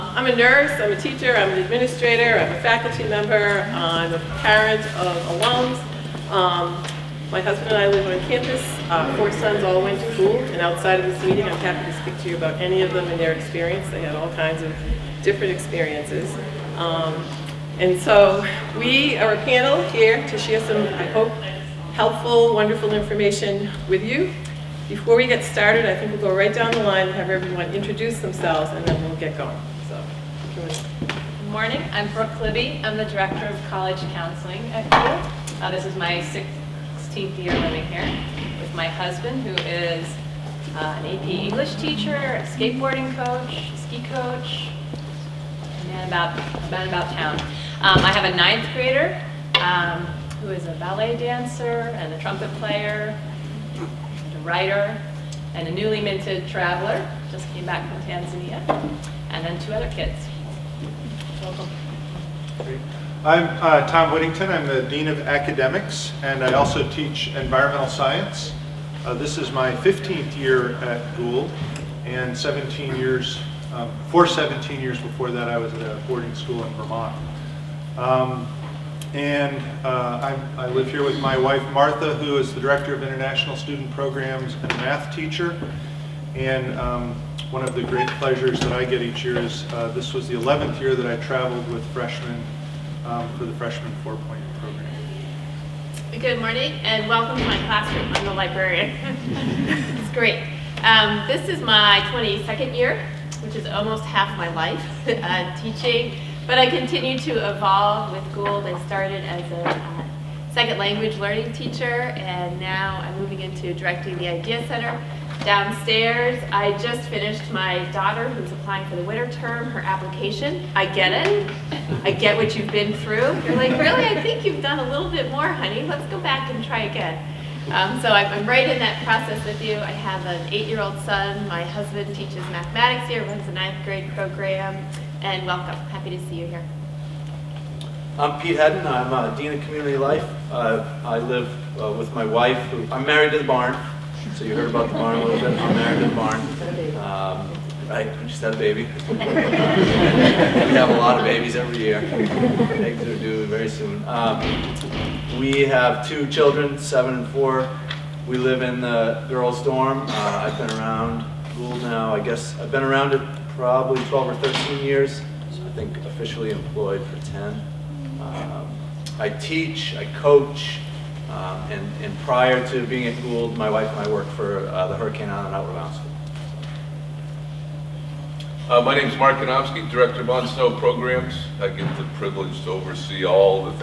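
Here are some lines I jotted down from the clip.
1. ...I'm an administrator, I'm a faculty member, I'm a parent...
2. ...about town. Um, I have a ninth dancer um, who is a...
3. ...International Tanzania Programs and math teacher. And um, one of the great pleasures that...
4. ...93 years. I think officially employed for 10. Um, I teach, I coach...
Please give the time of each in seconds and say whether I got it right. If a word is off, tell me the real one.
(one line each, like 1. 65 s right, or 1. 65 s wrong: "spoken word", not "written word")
1. 1 s right
2. 46 s wrong: "grader", not "dancer"
3. 83 s wrong: "Student", not "Tanzania"
4. 164 s wrong: "13", not "93".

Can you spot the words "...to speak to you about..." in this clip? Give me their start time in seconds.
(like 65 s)
11 s.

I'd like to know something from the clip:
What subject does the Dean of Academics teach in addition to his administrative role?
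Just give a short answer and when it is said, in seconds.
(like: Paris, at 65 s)
Environmental science, at 67 s.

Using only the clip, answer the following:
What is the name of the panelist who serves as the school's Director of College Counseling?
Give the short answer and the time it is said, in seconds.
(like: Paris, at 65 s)
Brooke Libby, at 32 s.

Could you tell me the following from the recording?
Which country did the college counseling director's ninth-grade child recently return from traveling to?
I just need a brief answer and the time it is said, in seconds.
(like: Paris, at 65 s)
Tanzania, at 58 s.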